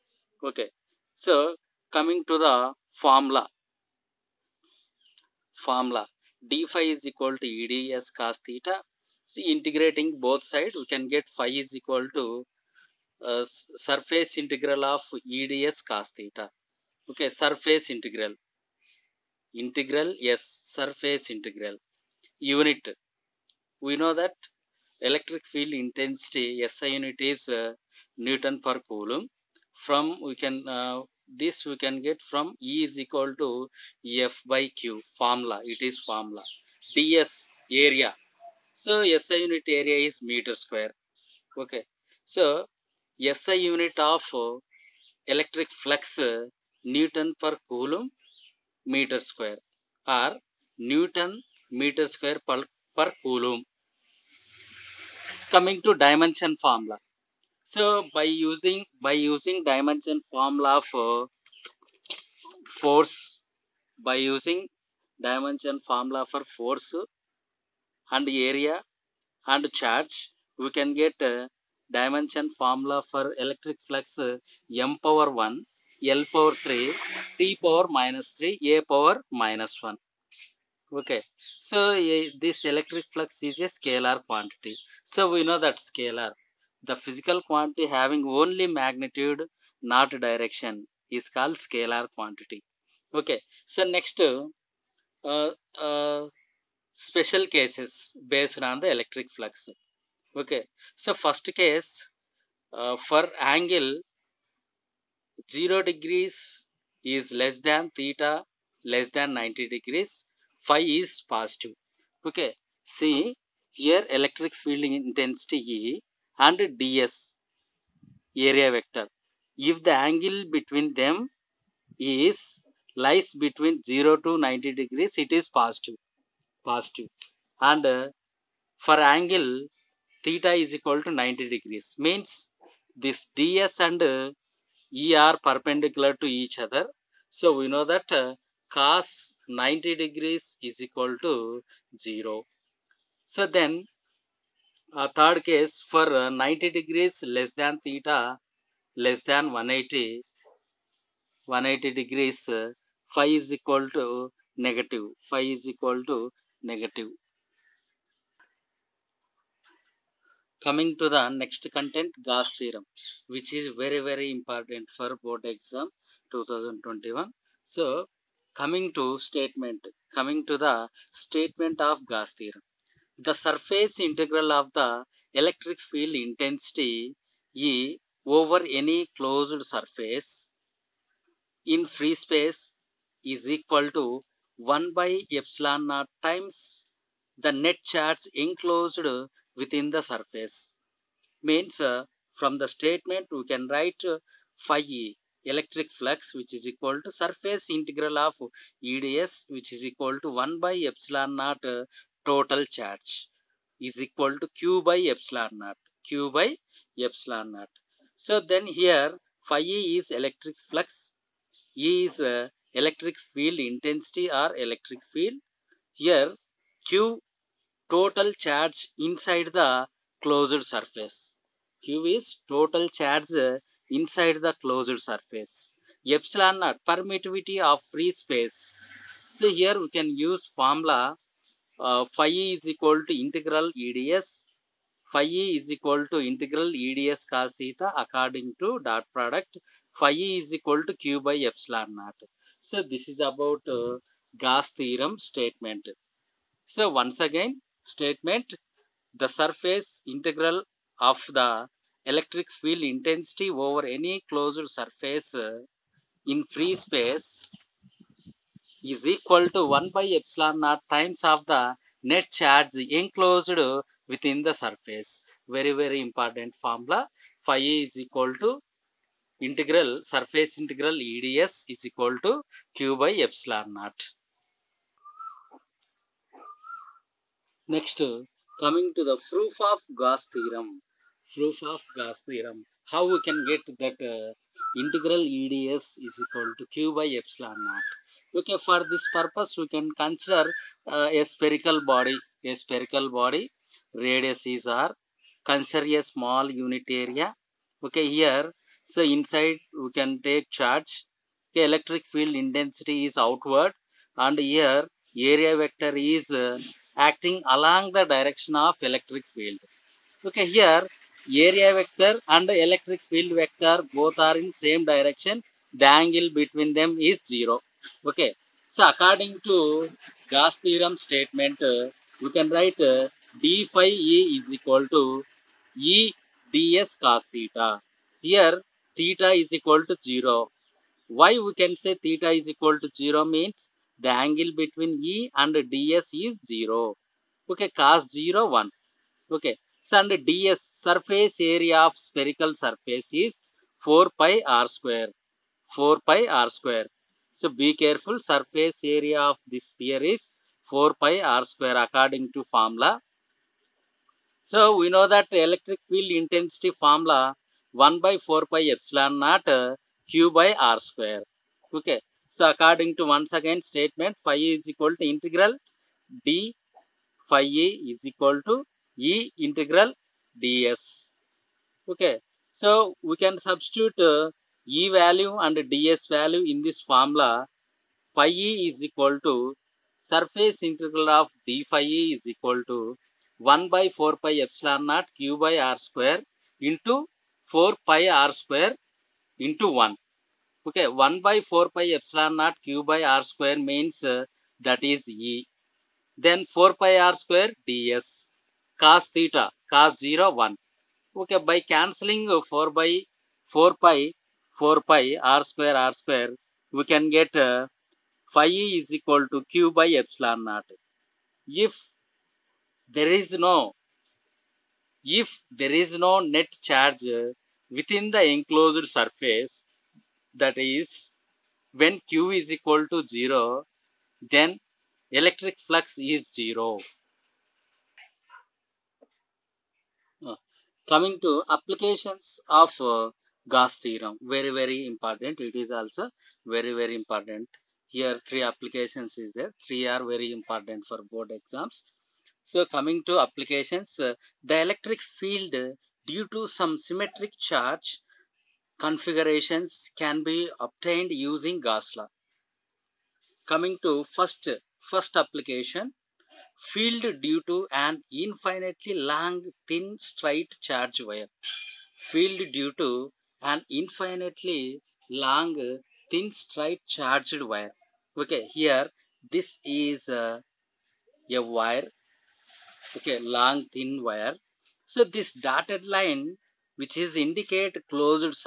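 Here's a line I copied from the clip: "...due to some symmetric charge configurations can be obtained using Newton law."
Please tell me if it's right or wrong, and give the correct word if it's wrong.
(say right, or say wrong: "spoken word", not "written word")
wrong: "Gauss", not "Newton".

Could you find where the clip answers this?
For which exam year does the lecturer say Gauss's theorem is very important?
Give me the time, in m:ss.
2:46.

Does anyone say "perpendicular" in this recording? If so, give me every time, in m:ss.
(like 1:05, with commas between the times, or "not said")
2:15.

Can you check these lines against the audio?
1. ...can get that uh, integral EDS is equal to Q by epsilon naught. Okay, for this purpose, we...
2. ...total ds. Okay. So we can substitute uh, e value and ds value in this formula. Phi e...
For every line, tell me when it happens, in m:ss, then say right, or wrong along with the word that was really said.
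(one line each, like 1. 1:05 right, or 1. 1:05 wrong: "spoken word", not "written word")
1. 4:43 right
2. 6:09 wrong: "integral", not "total".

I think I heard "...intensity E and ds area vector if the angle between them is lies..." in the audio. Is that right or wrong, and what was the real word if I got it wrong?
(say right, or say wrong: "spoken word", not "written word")
right.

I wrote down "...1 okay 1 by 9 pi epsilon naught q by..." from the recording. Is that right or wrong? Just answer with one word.
wrong.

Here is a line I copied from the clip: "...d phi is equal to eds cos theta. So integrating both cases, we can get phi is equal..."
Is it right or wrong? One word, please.
wrong.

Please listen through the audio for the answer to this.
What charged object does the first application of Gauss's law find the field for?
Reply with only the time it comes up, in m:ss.
7:38.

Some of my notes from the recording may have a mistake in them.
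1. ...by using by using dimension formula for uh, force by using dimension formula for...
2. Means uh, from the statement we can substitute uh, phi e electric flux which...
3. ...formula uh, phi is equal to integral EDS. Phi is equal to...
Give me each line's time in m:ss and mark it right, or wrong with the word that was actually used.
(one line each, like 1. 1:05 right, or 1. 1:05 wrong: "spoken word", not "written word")
1. 0:58 right
2. 3:11 wrong: "write", not "substitute"
3. 3:50 right.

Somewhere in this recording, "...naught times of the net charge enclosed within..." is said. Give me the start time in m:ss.
4:20.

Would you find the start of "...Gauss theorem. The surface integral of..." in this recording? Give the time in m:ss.
2:52.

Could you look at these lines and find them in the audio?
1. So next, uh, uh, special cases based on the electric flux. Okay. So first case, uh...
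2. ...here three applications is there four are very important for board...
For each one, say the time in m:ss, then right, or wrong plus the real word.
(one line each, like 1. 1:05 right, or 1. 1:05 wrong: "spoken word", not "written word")
1. 1:33 right
2. 7:17 wrong: "three", not "four".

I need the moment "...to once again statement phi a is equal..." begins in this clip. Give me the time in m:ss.
6:02.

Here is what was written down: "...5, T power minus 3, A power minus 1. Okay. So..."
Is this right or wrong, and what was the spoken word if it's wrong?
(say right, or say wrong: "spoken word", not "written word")
wrong: "3", not "5".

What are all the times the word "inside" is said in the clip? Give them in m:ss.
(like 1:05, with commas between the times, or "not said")
3:39, 3:43, 4:59.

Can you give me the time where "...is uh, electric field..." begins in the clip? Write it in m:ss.
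3:32.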